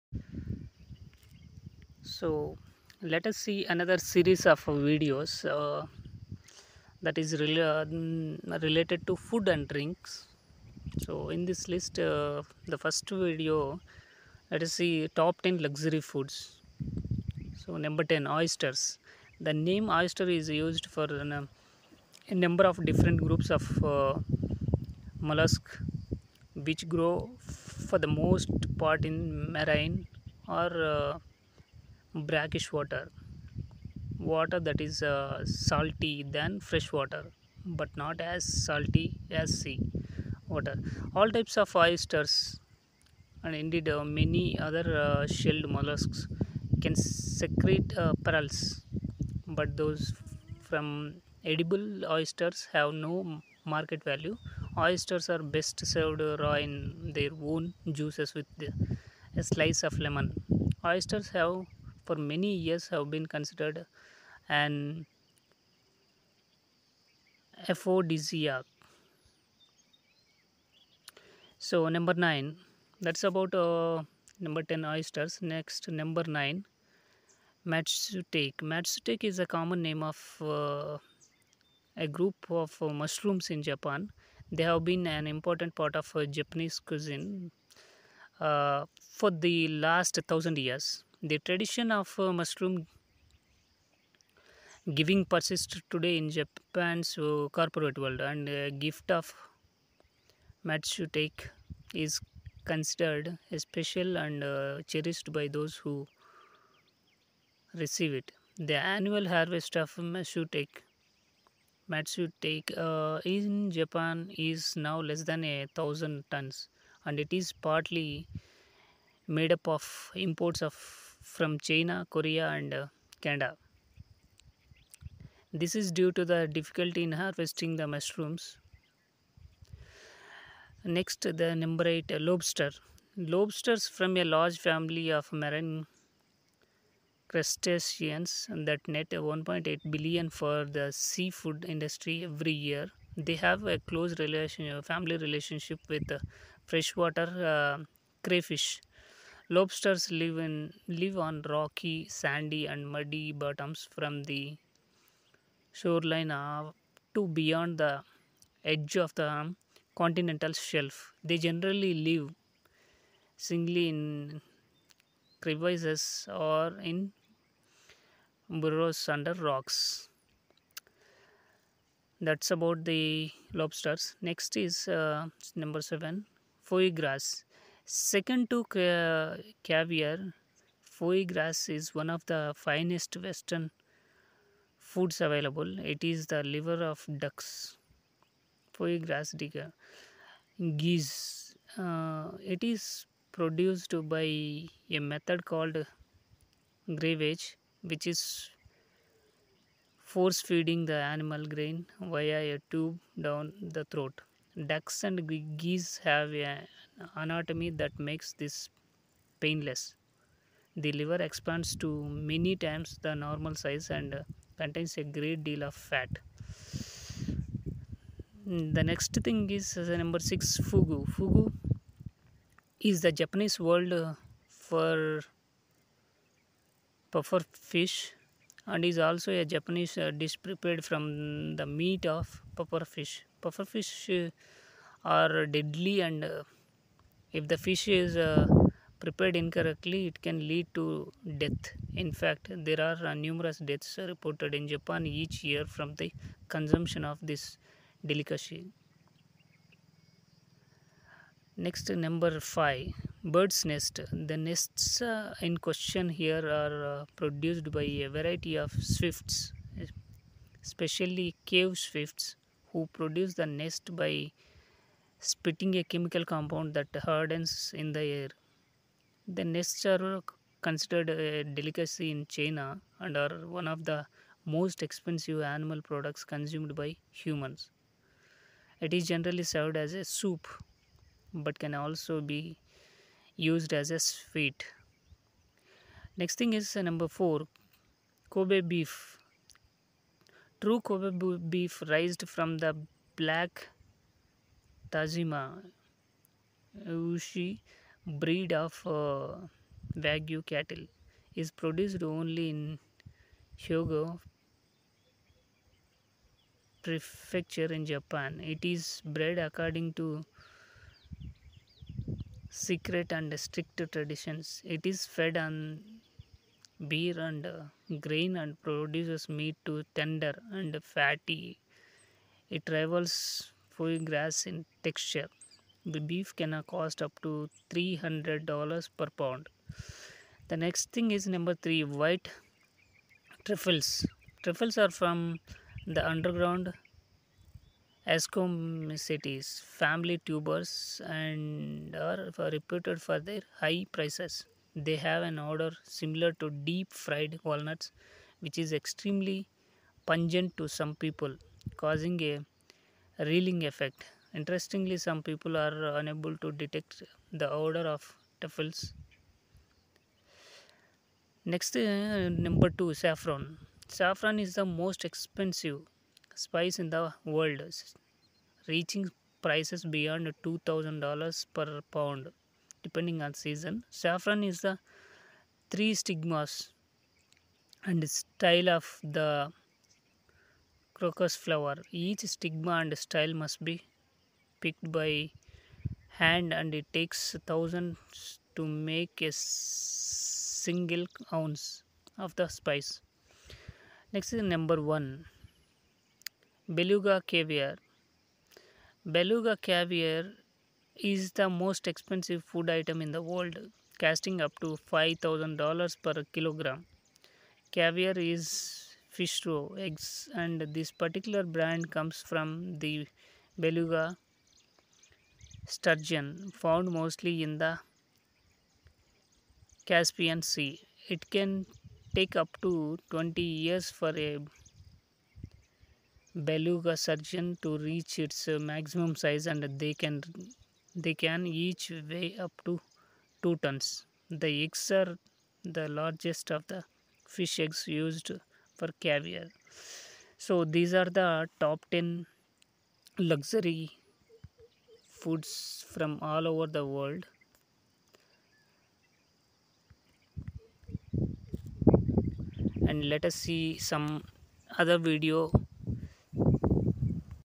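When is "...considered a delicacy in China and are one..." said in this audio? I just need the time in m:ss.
4:30.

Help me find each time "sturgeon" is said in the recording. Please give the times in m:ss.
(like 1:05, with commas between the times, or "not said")
6:55, 7:07.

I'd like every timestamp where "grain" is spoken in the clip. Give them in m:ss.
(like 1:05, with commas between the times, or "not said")
3:21, 5:18.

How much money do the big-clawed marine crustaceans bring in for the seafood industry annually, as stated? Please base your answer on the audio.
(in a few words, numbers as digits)
1.8 billion.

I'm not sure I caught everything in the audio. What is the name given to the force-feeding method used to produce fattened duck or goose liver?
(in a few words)
gravage.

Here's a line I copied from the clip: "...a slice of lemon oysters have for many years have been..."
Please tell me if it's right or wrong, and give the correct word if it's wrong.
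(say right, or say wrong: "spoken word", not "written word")
right.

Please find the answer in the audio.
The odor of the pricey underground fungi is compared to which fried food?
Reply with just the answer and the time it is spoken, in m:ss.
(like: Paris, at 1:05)
deep fried walnuts, at 5:46.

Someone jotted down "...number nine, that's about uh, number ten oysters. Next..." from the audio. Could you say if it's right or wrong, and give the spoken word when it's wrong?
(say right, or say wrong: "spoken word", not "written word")
right.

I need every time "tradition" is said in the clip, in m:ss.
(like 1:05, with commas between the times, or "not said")
1:31, 5:13.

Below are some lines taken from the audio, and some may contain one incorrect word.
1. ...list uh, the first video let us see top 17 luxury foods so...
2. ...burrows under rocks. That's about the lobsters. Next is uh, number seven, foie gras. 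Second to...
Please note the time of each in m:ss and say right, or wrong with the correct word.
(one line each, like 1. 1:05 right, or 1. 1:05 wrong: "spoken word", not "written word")
1. 0:11 wrong: "10", not "17"
2. 2:48 right.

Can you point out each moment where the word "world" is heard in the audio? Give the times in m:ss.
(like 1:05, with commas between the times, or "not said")
1:37, 6:07, 6:43, 7:26.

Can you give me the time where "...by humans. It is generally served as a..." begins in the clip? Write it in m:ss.
4:36.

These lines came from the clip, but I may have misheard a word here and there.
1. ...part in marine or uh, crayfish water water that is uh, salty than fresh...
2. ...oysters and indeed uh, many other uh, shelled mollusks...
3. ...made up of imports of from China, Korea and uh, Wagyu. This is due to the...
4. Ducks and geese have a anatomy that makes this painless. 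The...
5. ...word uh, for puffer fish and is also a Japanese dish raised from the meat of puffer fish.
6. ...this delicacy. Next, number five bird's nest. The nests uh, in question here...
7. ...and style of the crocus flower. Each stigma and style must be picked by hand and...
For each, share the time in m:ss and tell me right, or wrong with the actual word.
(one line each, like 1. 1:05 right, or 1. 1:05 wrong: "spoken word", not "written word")
1. 0:28 wrong: "brackish", not "crayfish"
2. 0:41 right
3. 1:59 wrong: "Canada", not "Wagyu"
4. 3:24 right
5. 3:43 wrong: "prepared", not "raised"
6. 4:07 right
7. 6:17 right.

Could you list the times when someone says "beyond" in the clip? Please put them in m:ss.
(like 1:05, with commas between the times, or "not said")
2:37, 6:09.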